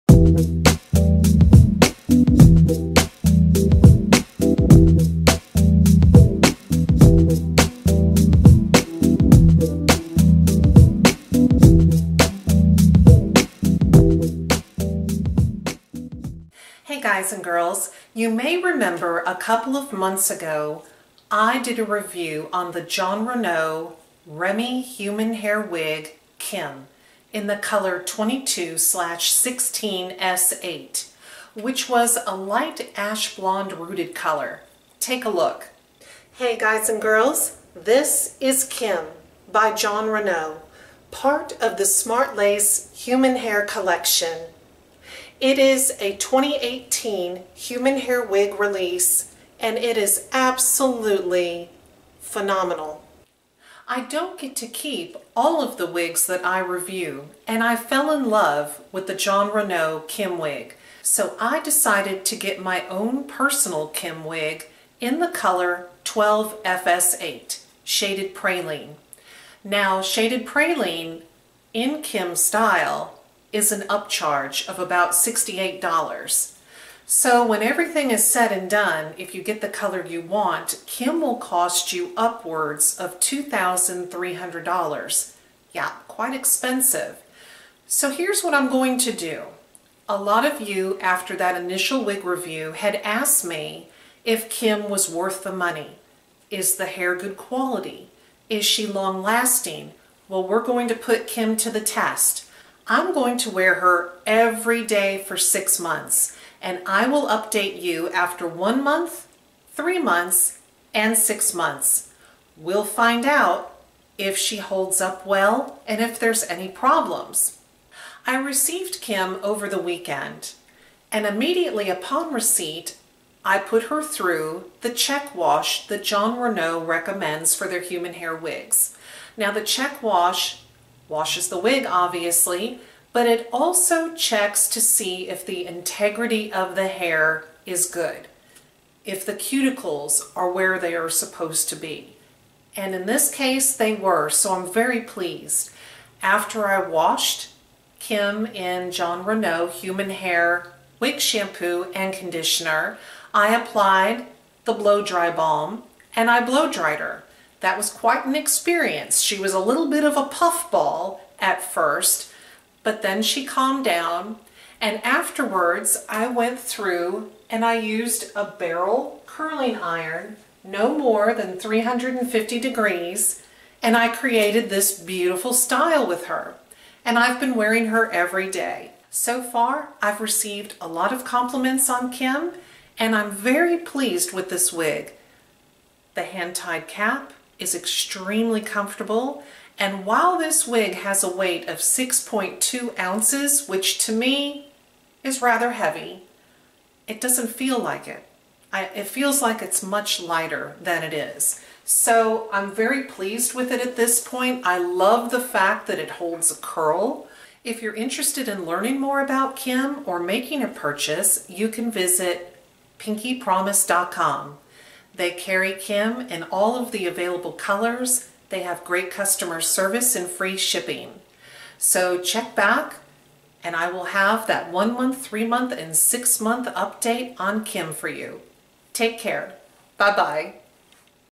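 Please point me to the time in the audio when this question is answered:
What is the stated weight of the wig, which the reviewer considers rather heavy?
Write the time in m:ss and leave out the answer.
3:11.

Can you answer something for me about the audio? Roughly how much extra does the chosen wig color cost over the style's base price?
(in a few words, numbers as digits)
$68.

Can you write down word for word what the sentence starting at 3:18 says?
I, it feels like it's much lighter than it is.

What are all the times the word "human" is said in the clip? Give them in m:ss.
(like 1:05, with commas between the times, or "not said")
0:24, 0:42, 0:47, 2:07, 2:29.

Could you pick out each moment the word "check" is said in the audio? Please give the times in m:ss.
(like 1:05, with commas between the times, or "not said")
2:04, 2:09, 2:14, 3:42.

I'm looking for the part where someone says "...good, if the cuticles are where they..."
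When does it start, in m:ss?
2:17.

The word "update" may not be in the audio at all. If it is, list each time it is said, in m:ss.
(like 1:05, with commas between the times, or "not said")
1:47, 3:46.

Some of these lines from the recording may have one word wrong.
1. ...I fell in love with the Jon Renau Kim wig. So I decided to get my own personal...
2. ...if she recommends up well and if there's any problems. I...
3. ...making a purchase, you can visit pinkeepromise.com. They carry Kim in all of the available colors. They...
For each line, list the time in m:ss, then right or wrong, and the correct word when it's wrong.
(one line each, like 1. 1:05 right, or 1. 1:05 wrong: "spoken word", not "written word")
1. 0:57 right
2. 1:54 wrong: "holds", not "recommends"
3. 3:30 right.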